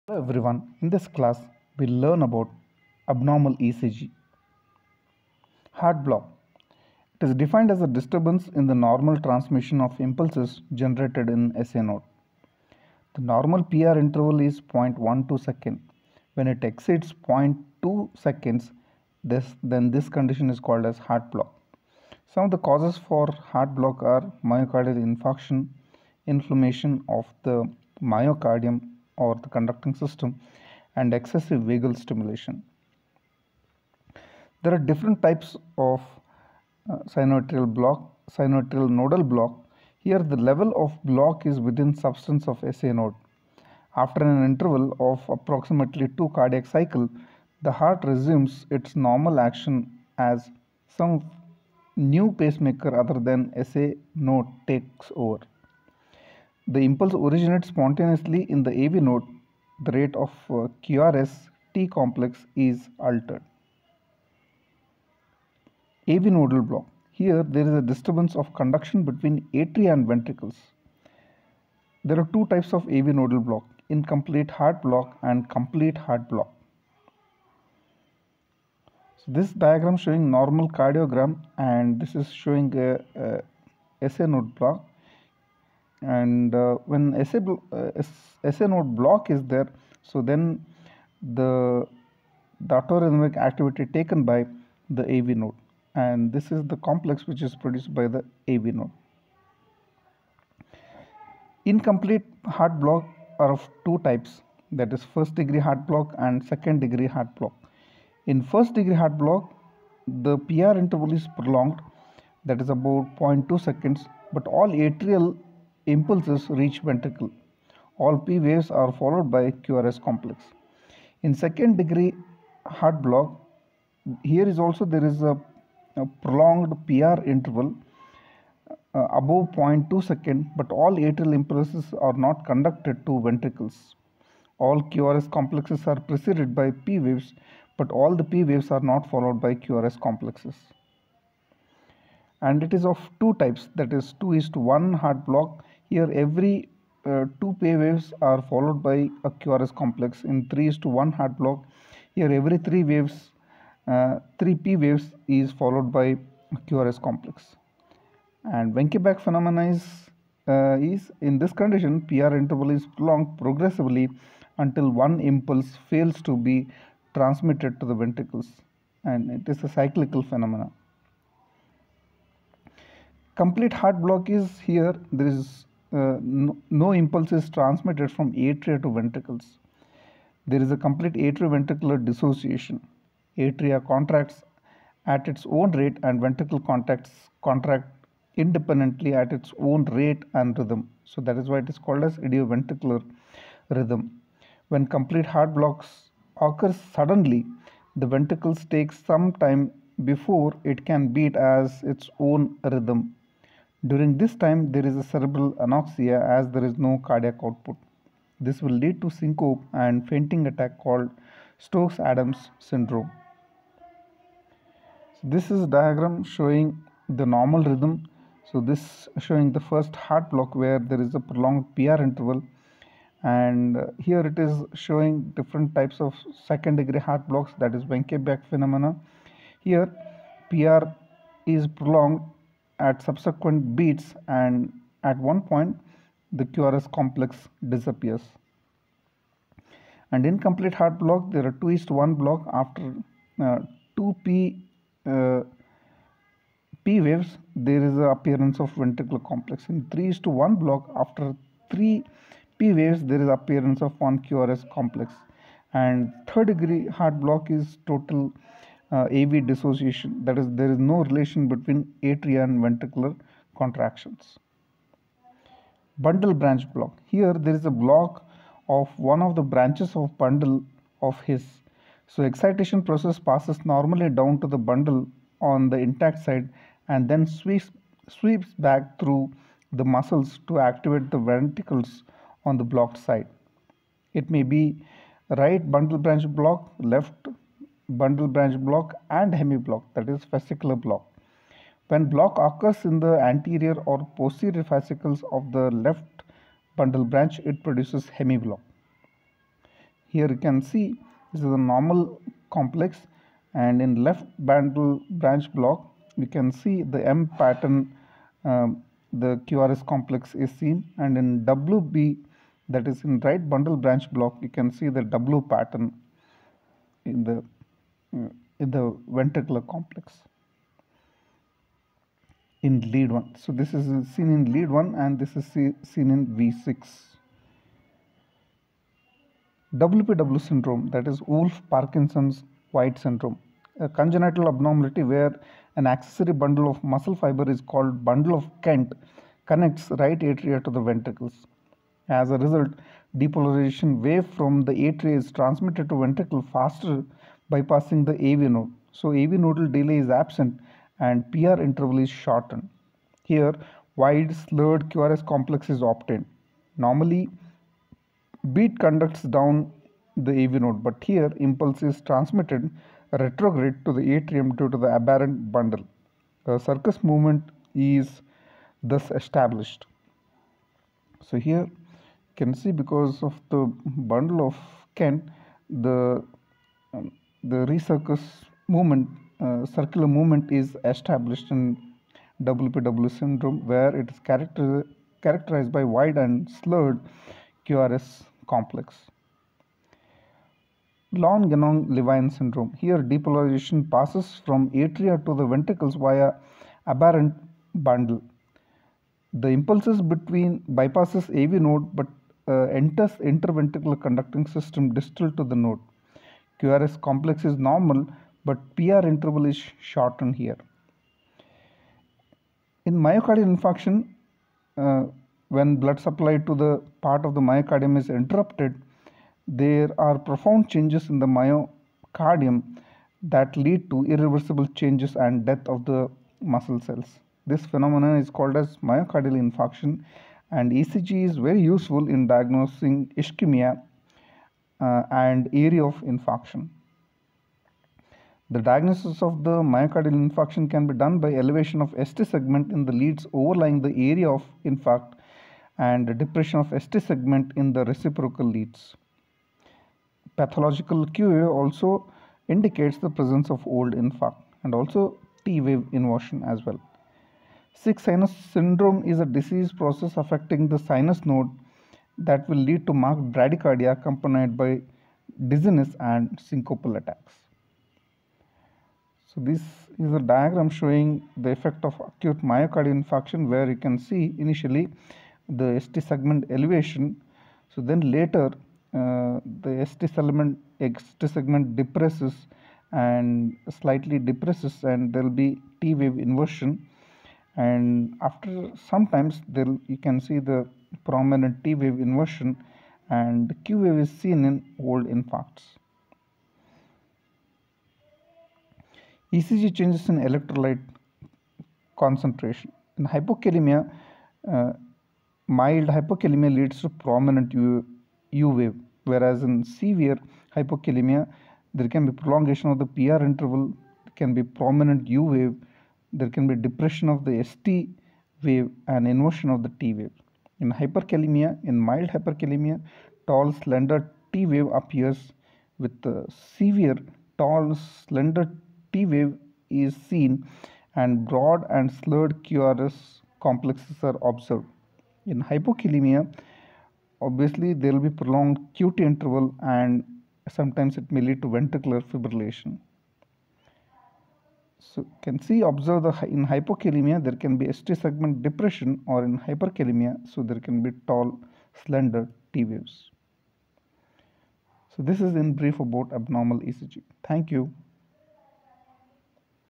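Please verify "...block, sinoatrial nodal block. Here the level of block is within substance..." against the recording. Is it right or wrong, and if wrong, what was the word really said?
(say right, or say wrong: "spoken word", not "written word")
right.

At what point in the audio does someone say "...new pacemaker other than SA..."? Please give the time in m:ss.
0:51.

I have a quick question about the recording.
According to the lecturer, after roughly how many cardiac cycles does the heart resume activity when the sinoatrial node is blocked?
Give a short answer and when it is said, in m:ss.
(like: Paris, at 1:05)
2, at 0:45.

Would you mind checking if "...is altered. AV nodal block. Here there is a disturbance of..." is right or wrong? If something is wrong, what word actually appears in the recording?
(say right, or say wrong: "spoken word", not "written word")
right.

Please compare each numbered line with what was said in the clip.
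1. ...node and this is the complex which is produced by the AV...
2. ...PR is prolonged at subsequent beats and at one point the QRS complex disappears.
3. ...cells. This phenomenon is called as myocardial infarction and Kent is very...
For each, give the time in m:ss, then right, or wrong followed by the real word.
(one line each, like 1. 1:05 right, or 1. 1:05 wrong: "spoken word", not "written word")
1. 1:35 right
2. 3:50 right
3. 7:06 wrong: "ECG", not "Kent".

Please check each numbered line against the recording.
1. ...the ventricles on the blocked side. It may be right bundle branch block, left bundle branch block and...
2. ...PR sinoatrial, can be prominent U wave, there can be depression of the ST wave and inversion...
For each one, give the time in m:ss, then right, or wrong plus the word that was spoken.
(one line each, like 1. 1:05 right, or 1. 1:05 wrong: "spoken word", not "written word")
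1. 4:41 right
2. 8:32 wrong: "interval", not "sinoatrial".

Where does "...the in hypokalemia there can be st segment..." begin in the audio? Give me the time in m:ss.
9:06.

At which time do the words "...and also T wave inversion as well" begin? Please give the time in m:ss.
7:34.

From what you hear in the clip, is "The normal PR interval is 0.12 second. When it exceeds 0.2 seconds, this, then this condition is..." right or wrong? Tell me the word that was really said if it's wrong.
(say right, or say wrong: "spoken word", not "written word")
right.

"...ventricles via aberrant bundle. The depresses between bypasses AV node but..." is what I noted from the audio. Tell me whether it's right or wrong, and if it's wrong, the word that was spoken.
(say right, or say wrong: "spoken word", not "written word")
wrong: "impulses", not "depresses".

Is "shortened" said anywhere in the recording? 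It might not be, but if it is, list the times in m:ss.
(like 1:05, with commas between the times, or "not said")
5:52, 6:49.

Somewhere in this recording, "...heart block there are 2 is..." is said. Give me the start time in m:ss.
4:00.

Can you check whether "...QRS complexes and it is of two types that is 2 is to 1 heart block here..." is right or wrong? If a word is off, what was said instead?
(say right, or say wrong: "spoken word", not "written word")
right.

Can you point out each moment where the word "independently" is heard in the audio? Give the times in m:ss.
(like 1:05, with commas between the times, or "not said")
3:08.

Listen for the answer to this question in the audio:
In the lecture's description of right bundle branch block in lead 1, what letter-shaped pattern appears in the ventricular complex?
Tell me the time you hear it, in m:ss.
5:15.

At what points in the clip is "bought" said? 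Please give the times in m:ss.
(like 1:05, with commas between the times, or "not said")
not said.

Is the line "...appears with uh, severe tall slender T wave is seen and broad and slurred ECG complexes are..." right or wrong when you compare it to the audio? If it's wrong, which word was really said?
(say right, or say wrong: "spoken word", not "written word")
wrong: "QRS", not "ECG".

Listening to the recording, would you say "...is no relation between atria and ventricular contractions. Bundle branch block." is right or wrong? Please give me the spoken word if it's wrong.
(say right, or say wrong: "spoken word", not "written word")
right.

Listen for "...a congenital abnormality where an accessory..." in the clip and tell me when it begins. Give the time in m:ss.
5:33.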